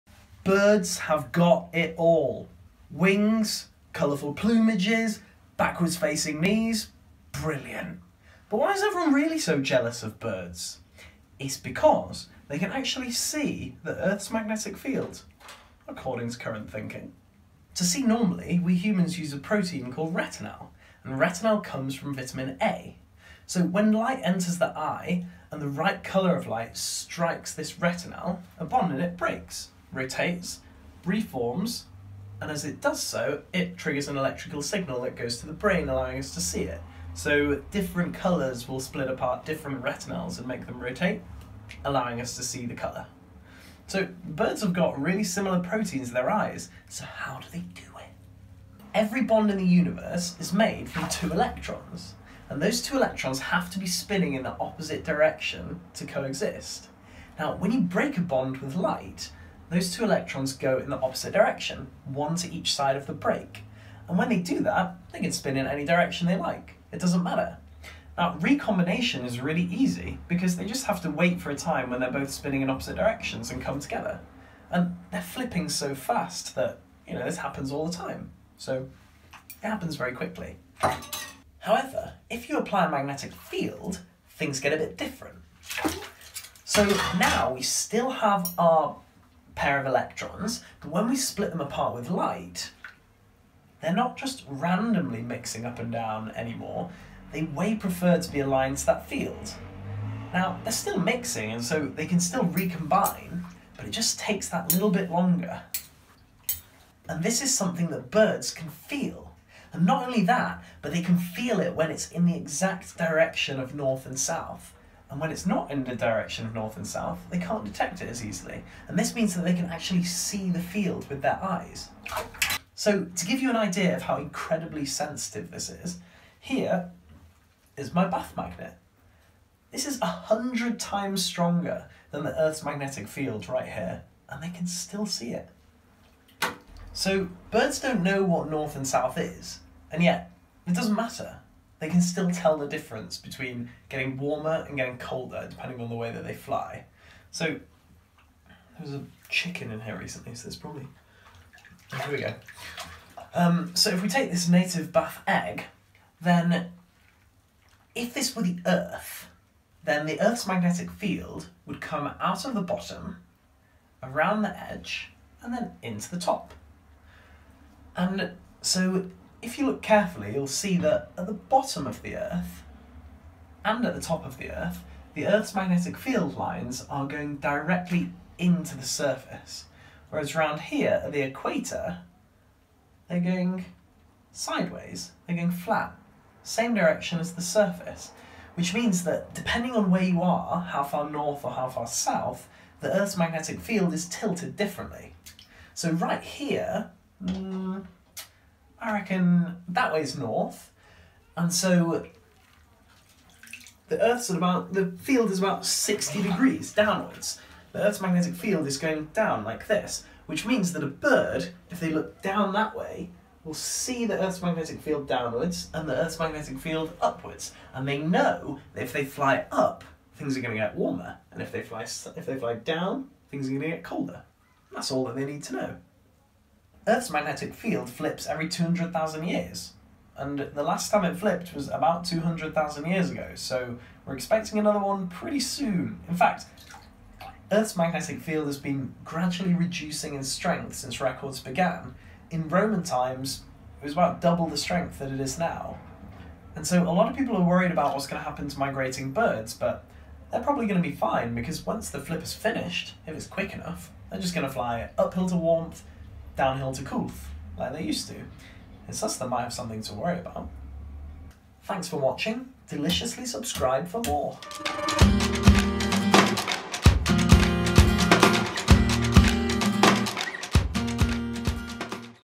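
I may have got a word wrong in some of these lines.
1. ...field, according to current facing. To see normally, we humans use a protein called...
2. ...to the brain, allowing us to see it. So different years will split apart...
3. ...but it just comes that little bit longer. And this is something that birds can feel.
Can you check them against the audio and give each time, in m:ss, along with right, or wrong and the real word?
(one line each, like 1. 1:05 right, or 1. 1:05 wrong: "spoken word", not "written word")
1. 0:14 wrong: "thinking", not "facing"
2. 0:35 wrong: "colours", not "years"
3. 1:43 wrong: "takes", not "comes".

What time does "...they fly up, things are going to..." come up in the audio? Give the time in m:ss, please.
3:38.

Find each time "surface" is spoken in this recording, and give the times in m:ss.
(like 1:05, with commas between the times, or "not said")
2:58, 3:07.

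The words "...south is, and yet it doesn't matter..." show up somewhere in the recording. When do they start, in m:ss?
2:18.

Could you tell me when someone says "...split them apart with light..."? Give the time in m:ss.
1:31.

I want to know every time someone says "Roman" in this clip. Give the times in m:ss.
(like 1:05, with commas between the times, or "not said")
4:02.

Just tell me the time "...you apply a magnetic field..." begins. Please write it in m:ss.
1:22.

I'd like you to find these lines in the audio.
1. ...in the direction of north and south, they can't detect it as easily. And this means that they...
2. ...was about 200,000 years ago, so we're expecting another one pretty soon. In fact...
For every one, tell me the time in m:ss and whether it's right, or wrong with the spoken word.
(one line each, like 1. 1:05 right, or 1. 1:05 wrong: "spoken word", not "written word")
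1. 1:55 right
2. 3:51 right.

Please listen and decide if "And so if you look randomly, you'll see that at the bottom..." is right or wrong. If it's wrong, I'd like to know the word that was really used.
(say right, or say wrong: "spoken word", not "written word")
wrong: "carefully", not "randomly".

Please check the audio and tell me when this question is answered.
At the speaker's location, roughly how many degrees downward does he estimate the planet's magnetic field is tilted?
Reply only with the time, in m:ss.
3:25.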